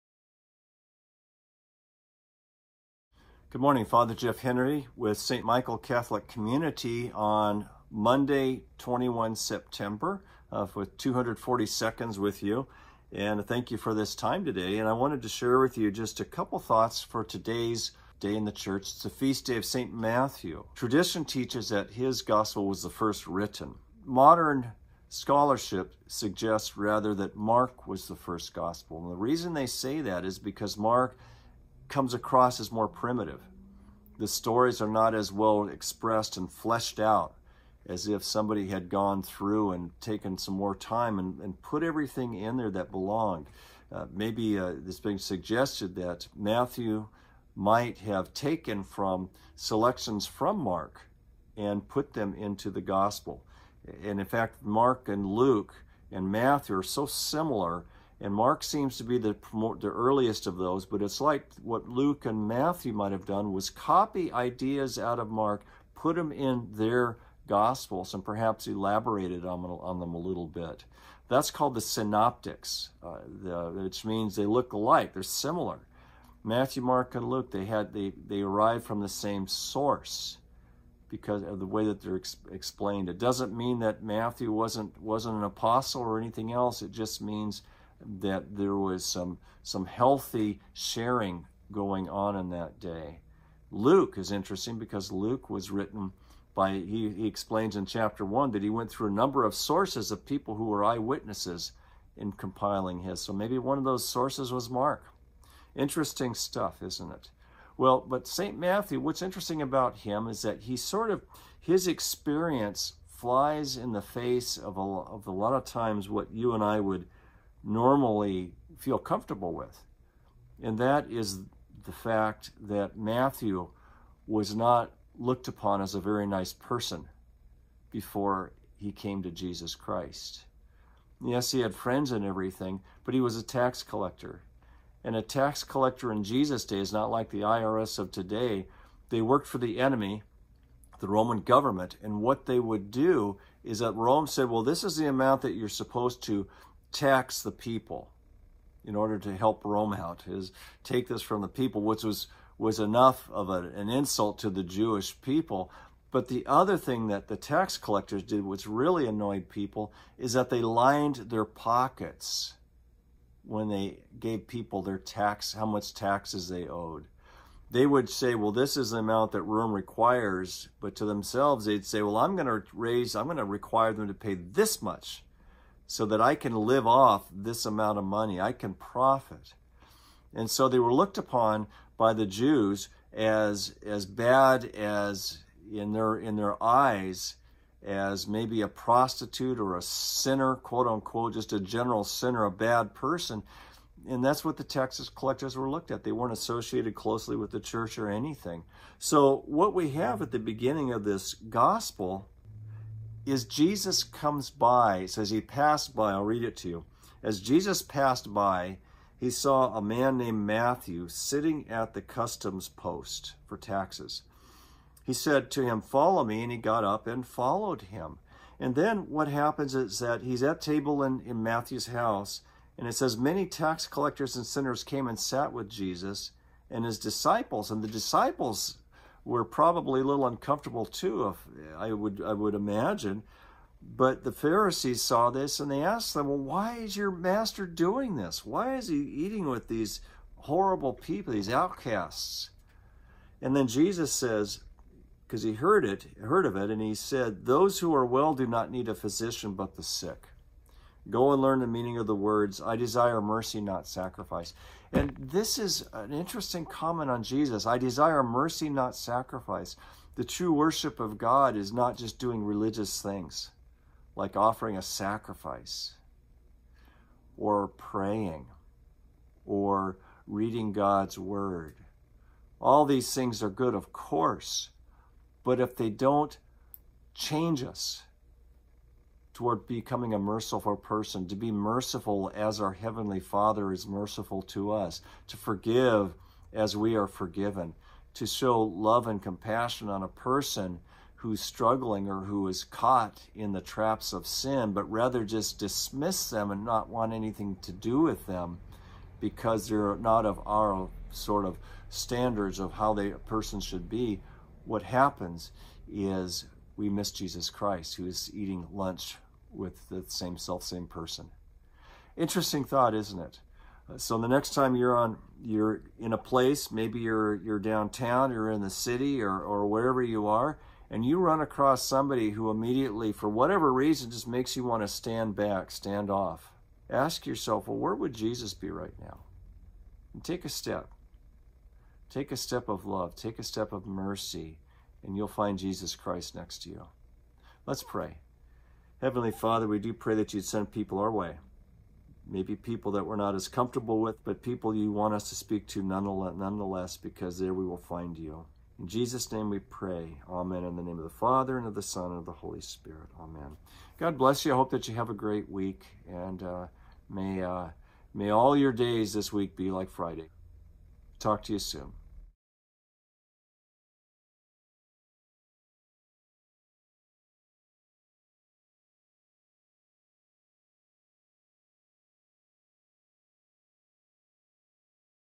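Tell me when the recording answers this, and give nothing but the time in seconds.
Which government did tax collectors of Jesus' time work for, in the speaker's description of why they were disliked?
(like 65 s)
140 s.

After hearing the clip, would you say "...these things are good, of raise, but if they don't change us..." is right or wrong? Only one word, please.
wrong.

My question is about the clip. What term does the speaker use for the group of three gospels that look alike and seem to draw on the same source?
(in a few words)
the synoptics.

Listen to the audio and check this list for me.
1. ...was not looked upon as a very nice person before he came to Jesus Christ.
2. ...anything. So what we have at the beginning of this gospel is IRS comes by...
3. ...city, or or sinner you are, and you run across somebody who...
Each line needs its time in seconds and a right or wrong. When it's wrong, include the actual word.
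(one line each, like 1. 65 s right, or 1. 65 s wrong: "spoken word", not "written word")
1. 124 s right
2. 198 s wrong: "Jesus", not "IRS"
3. 318 s wrong: "wherever", not "sinner".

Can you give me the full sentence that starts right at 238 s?
Why is he eating with these horrible people, these outcasts?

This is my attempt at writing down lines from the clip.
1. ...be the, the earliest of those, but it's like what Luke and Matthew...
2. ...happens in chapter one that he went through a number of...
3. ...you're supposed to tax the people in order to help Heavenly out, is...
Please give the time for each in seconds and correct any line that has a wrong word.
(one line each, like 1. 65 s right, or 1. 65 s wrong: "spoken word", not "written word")
1. 59 s right
2. 97 s wrong: "explains", not "happens"
3. 145 s wrong: "Rome", not "Heavenly".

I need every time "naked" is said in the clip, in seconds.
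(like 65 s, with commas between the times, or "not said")
not said.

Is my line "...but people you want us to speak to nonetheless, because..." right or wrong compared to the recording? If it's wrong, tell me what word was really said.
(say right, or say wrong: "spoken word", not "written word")
right.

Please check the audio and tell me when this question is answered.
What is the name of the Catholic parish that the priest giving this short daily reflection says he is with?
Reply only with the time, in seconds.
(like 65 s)
5 s.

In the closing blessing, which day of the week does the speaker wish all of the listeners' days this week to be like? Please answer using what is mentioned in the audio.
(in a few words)
Friday.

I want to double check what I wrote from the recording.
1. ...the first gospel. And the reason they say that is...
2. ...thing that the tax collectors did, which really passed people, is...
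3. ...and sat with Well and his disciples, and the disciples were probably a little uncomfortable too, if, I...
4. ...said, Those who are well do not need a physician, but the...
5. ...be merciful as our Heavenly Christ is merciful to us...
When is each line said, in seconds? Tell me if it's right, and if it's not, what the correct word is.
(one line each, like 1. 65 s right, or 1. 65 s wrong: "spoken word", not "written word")
1. 28 s right
2. 156 s wrong: "annoyed", not "passed"
3. 225 s wrong: "Jesus", not "Well"
4. 246 s right
5. 281 s wrong: "Father", not "Christ".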